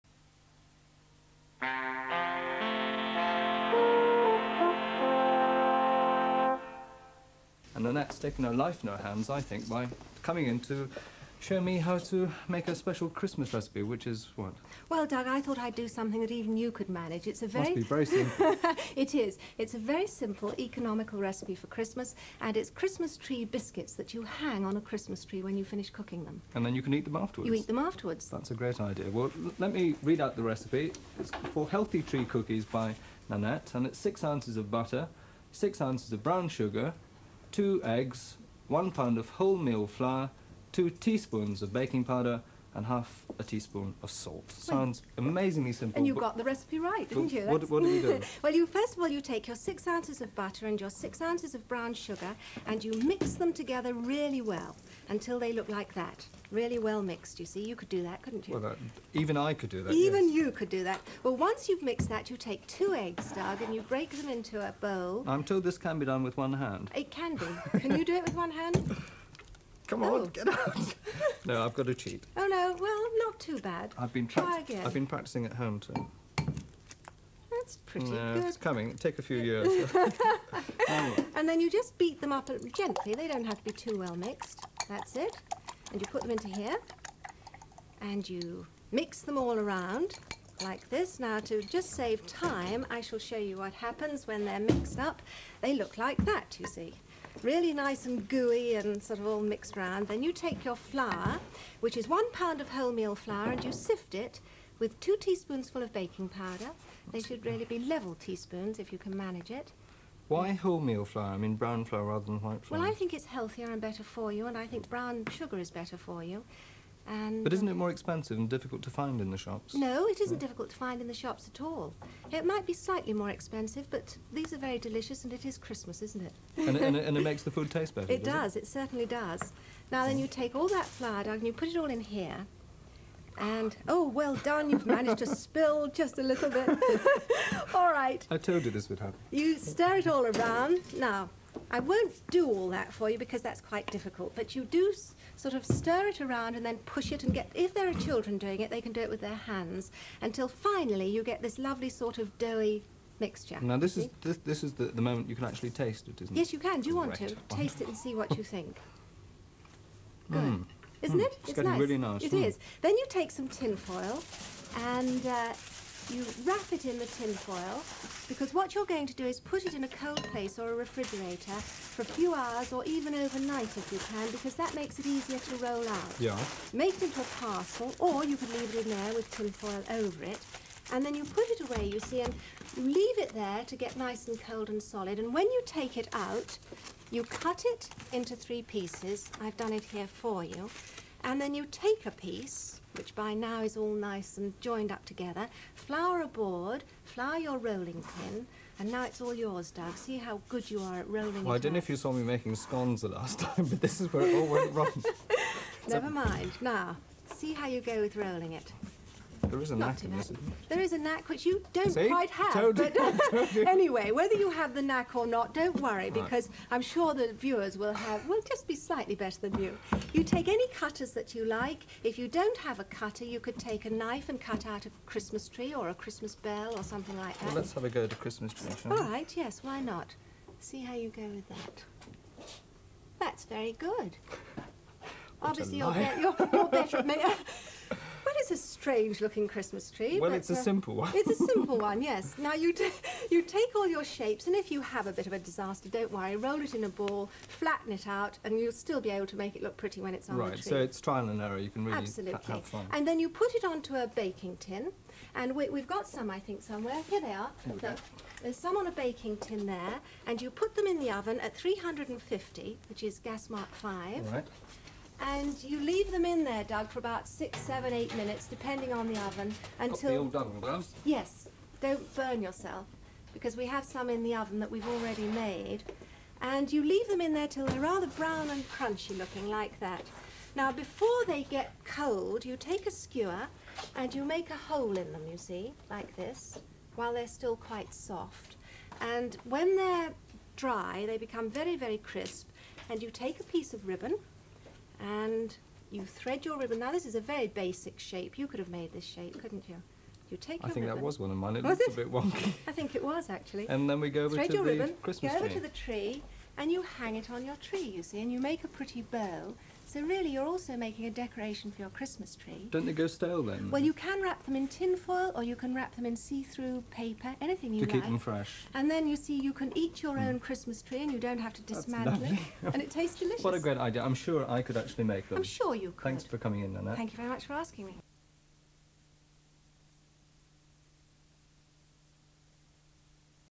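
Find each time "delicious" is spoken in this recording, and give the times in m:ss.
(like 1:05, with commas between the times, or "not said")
2:04, 5:23.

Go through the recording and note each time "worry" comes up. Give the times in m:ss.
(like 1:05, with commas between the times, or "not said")
3:35, 4:06.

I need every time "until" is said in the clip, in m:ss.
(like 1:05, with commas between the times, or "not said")
0:55, 2:30, 4:29.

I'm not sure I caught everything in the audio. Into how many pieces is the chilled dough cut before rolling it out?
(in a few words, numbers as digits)
3.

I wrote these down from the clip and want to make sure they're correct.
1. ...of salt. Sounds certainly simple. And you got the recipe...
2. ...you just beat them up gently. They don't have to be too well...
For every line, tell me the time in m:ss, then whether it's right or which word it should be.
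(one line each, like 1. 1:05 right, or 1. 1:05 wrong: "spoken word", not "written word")
1. 0:44 wrong: "amazingly", not "certainly"
2. 1:21 right.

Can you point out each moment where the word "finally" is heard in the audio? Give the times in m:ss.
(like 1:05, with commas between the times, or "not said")
2:30.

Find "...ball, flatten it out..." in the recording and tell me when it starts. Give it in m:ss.
4:06.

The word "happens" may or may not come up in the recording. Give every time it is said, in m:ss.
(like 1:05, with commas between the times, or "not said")
1:33, 2:18.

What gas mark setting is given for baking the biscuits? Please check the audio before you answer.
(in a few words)
gas mark 5.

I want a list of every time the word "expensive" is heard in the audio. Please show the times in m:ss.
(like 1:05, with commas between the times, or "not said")
1:57, 2:03.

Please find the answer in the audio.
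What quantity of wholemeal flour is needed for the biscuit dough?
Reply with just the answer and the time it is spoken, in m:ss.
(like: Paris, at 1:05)
1 pound, at 0:38.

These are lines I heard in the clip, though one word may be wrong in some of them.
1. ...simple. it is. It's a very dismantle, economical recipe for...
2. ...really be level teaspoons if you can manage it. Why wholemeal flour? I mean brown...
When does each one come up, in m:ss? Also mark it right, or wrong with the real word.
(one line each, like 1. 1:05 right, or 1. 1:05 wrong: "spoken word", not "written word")
1. 0:18 wrong: "simple", not "dismantle"
2. 1:47 right.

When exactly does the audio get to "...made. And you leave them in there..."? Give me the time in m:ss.
4:35.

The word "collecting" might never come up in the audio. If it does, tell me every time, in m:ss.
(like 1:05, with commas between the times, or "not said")
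not said.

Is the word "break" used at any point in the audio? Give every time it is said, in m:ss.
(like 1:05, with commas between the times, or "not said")
1:03.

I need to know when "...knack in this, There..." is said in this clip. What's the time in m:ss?
3:29.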